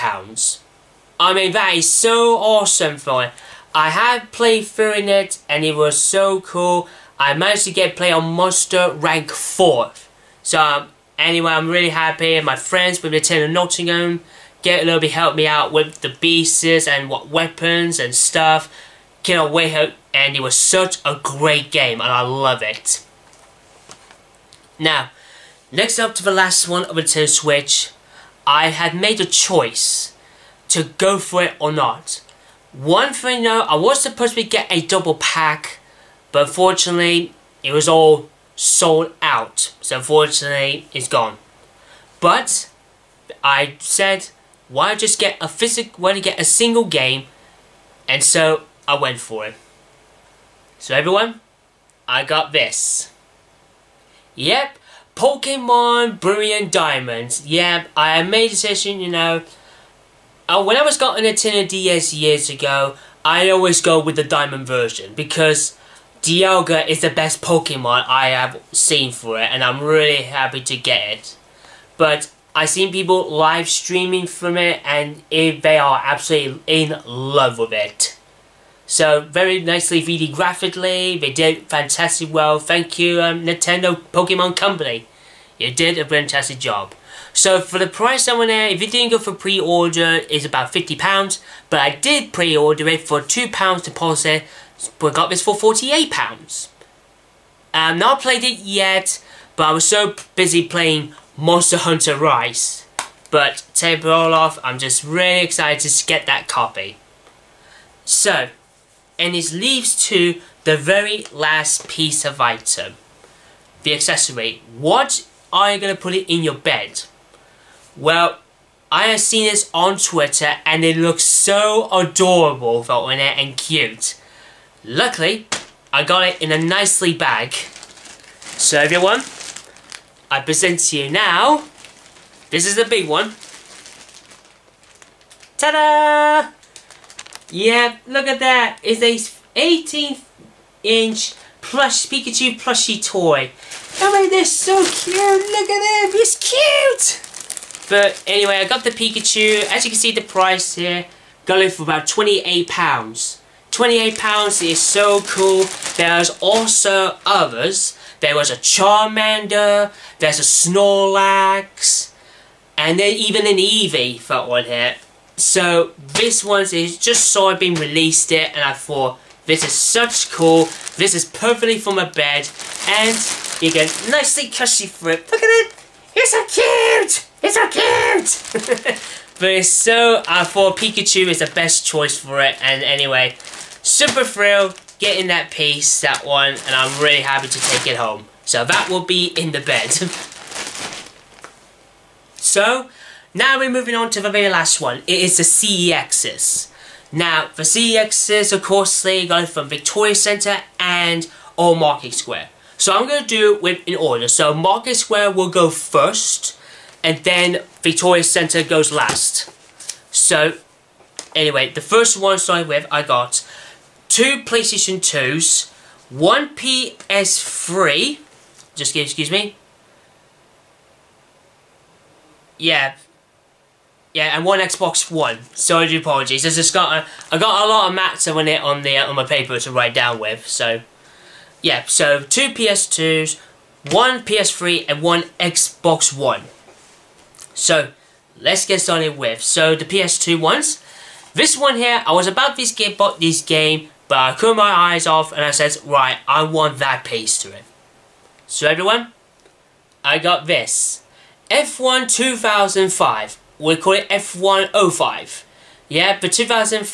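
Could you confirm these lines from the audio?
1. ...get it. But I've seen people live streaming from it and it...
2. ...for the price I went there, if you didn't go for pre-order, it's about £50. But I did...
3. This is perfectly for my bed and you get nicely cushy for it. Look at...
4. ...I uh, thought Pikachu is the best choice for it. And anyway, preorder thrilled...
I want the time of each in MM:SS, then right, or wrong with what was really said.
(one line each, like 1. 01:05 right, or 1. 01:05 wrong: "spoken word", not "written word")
1. 01:10 right
2. 01:27 right
3. 02:50 right
4. 03:00 wrong: "super", not "preorder".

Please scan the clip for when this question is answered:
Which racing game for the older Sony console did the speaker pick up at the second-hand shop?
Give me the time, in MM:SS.
04:11.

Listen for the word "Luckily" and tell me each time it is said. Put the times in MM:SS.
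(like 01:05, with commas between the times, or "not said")
02:04.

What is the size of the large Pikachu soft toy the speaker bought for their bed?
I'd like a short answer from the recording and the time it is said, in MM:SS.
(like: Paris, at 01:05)
18 inch, at 02:19.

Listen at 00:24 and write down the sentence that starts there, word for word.
Now, next up to the last one of the Nintendo Switch, I had made a choice to go for it or not.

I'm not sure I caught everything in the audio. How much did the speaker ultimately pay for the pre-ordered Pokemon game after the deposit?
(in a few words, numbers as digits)
£48.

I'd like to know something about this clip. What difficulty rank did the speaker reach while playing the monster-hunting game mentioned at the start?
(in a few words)
Monster Rank 4.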